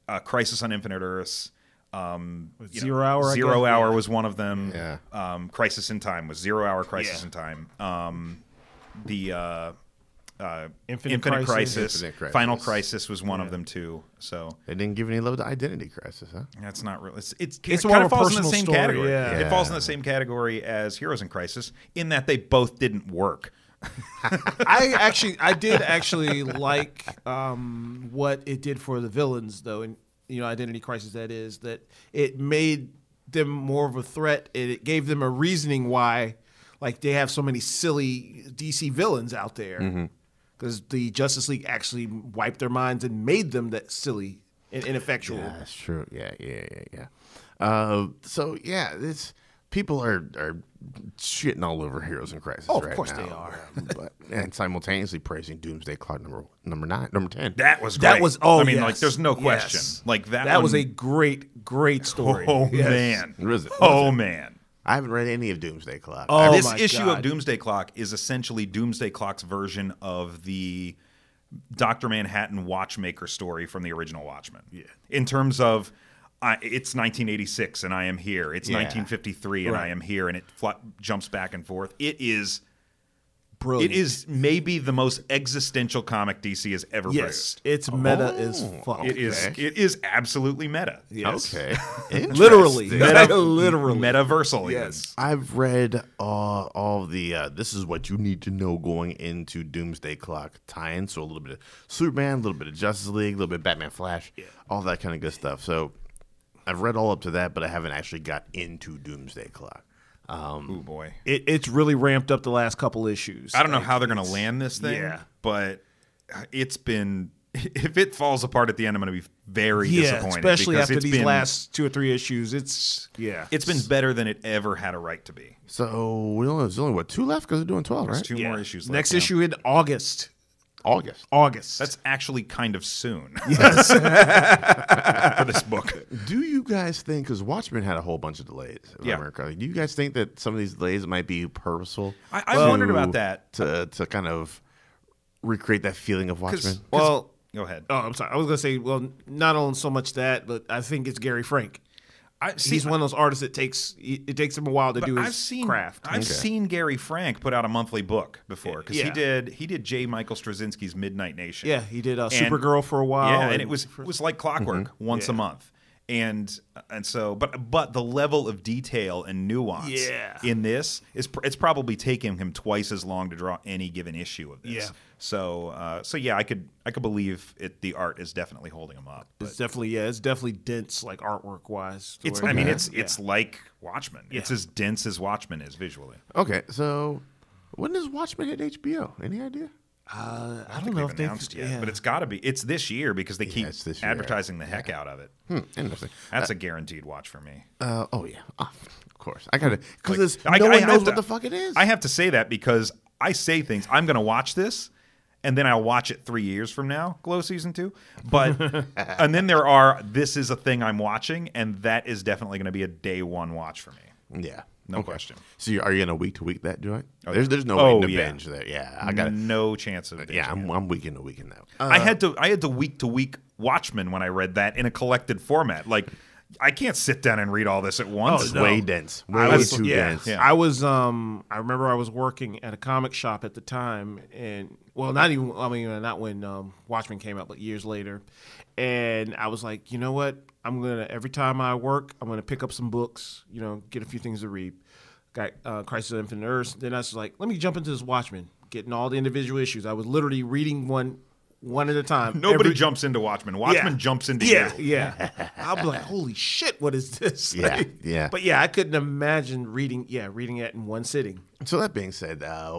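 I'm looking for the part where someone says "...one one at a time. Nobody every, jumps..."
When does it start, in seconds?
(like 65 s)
250 s.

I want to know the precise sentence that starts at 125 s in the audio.
So we only there's only what two left because they're doing twelve, right?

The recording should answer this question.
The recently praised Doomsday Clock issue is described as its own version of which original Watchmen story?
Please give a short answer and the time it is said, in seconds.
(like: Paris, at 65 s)
Doctor Manhattan Watchmaker, at 71 s.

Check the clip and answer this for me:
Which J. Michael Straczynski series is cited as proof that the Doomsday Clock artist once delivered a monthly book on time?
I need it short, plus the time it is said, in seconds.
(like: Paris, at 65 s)
Midnight Nation, at 160 s.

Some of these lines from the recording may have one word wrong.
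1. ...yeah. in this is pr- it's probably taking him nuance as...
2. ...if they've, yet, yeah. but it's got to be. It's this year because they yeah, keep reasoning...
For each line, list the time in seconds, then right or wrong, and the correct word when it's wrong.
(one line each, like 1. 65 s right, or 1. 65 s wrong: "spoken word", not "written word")
1. 170 s wrong: "twice", not "nuance"
2. 191 s wrong: "advertising", not "reasoning".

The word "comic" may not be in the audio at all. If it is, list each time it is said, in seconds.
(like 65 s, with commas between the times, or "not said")
86 s, 232 s.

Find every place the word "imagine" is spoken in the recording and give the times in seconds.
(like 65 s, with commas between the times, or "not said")
258 s.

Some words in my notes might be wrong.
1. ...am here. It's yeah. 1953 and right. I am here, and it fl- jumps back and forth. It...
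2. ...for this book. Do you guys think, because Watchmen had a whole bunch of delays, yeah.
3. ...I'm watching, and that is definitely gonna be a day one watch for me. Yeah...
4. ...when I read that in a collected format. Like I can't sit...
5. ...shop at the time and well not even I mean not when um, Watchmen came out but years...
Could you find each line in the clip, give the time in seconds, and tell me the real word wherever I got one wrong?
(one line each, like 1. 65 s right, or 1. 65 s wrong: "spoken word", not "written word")
1. 78 s right
2. 135 s right
3. 210 s right
4. 224 s right
5. 233 s right.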